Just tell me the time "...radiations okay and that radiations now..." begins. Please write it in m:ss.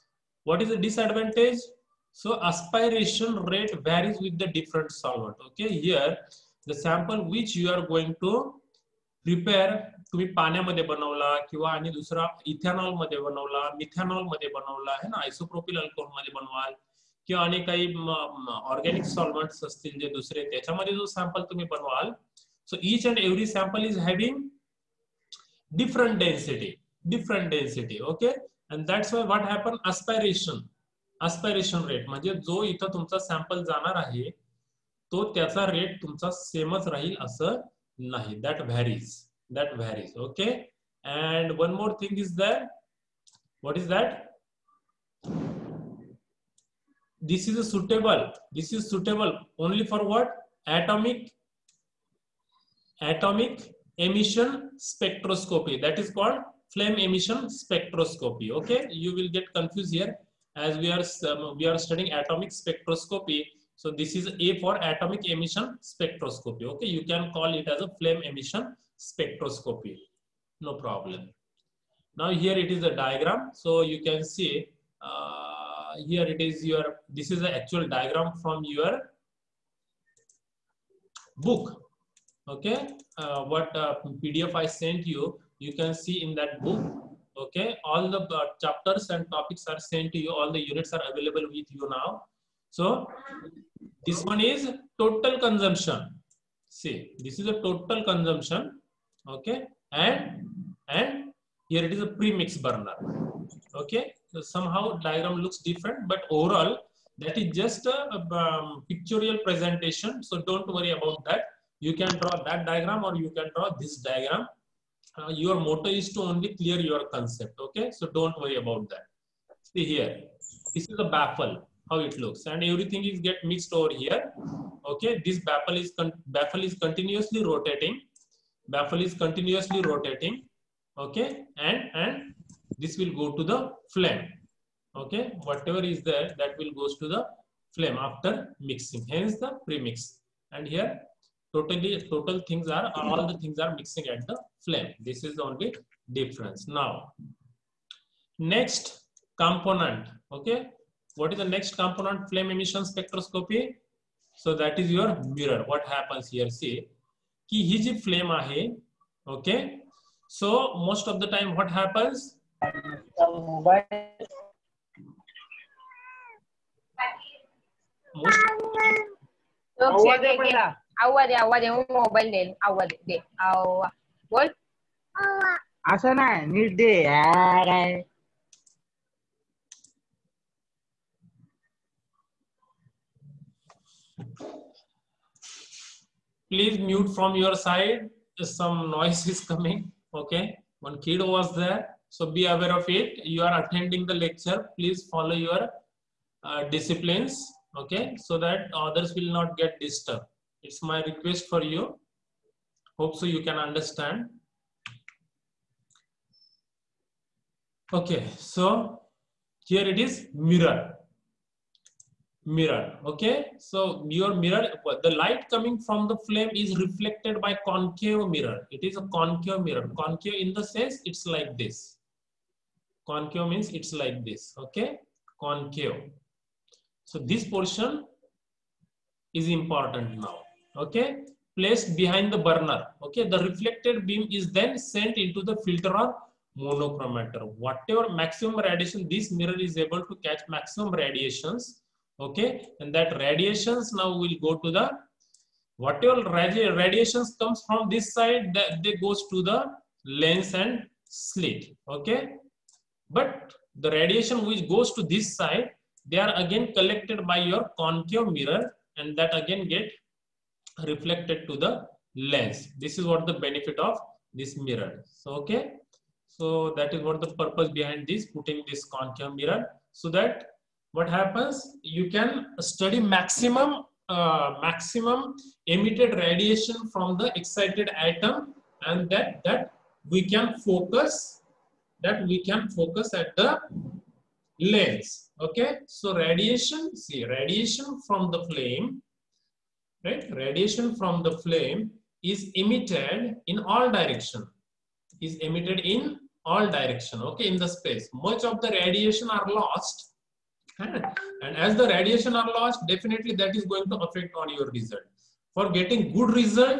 4:01.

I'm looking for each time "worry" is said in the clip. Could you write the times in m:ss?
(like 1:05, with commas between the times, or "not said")
1:50, 1:58.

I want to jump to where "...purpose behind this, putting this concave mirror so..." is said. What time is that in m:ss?
4:27.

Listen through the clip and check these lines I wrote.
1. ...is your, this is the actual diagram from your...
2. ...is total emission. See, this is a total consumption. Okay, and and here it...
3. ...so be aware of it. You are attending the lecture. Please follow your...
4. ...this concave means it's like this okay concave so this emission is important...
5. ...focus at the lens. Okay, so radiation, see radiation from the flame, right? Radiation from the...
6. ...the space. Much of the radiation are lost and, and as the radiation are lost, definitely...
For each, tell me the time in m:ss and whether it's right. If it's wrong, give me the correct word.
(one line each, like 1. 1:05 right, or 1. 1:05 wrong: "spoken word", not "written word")
1. 1:16 right
2. 1:34 wrong: "consumption", not "emission"
3. 3:12 right
4. 3:41 wrong: "portion", not "emission"
5. 4:42 right
6. 4:57 right.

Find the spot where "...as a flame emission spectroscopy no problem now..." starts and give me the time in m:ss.
1:07.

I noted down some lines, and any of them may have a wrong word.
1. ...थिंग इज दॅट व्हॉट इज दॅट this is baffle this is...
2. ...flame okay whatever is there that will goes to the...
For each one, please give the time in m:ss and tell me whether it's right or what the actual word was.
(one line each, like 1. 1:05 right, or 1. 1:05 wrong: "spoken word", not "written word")
1. 0:42 wrong: "suitable", not "baffle"
2. 2:13 right.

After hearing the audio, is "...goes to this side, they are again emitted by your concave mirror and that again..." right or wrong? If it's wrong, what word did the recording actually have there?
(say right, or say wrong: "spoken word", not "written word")
wrong: "collected", not "emitted".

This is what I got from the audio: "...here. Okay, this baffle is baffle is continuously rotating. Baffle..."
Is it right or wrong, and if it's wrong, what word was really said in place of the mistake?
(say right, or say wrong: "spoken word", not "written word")
right.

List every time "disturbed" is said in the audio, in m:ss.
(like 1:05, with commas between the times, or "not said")
3:19.